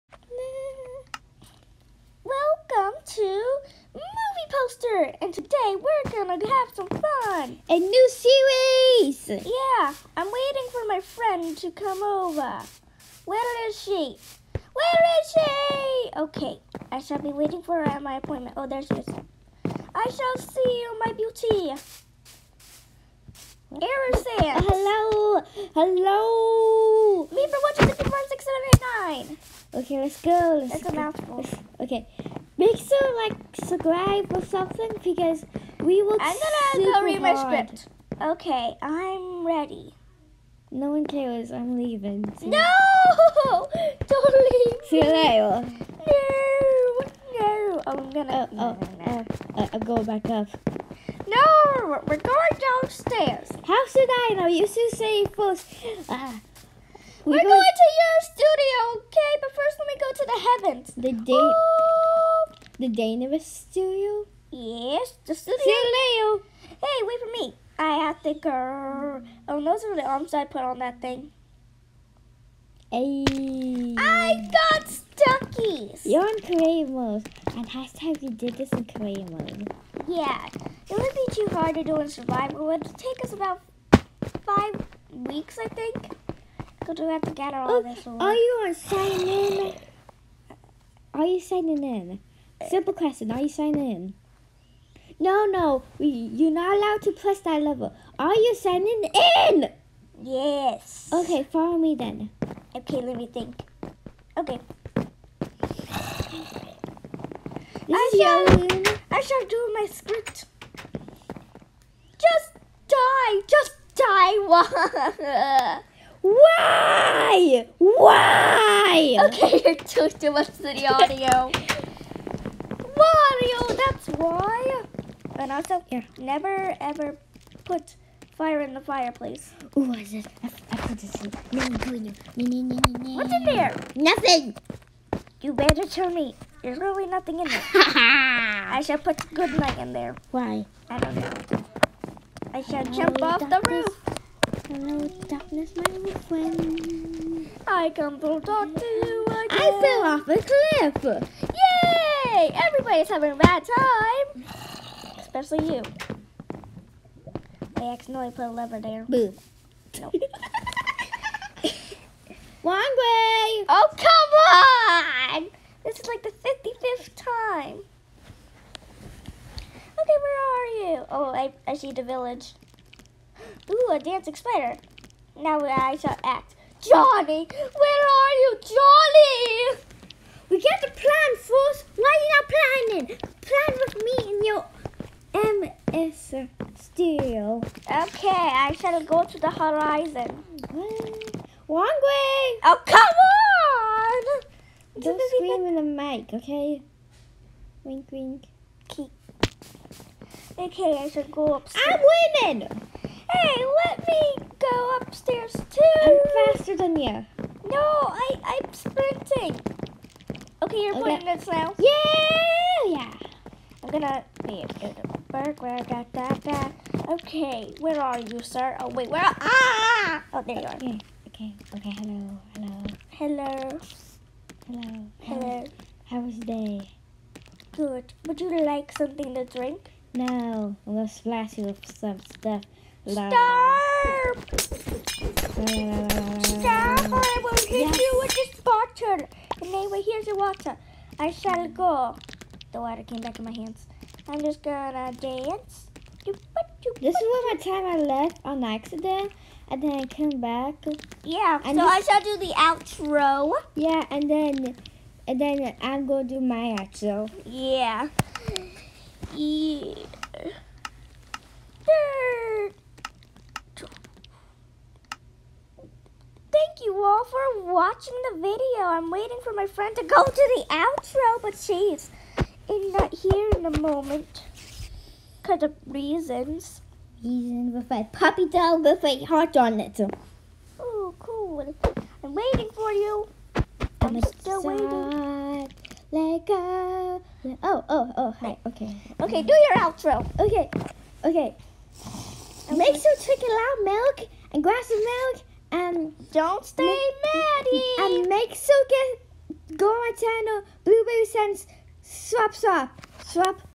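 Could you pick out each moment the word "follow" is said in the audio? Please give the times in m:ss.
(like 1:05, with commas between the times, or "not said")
1:41.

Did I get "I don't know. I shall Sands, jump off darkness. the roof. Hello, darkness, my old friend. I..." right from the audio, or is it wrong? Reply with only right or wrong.
wrong.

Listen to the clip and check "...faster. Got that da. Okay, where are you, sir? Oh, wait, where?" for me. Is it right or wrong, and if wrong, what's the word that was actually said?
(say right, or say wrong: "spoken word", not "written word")
wrong: "burger", not "faster".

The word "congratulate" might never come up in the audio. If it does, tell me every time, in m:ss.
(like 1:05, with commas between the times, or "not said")
not said.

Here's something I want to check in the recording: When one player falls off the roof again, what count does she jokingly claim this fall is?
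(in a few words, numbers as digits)
55th time.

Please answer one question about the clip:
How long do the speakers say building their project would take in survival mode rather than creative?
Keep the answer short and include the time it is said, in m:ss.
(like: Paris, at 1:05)
5 weeks, at 1:24.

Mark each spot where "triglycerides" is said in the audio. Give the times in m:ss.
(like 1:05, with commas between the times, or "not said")
not said.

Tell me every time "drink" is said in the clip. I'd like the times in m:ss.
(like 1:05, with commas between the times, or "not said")
3:49, 4:53.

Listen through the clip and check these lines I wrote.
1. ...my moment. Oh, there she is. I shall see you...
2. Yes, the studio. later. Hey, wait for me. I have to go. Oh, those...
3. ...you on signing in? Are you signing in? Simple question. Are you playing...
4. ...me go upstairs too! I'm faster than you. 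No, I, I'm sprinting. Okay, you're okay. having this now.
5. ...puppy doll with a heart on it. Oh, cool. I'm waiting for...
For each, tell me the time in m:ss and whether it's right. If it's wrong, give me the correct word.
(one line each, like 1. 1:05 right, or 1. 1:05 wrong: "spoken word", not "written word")
1. 0:18 wrong: "appointment", not "moment"
2. 1:04 right
3. 1:28 wrong: "signing", not "playing"
4. 3:24 wrong: "playing", not "having"
5. 4:38 right.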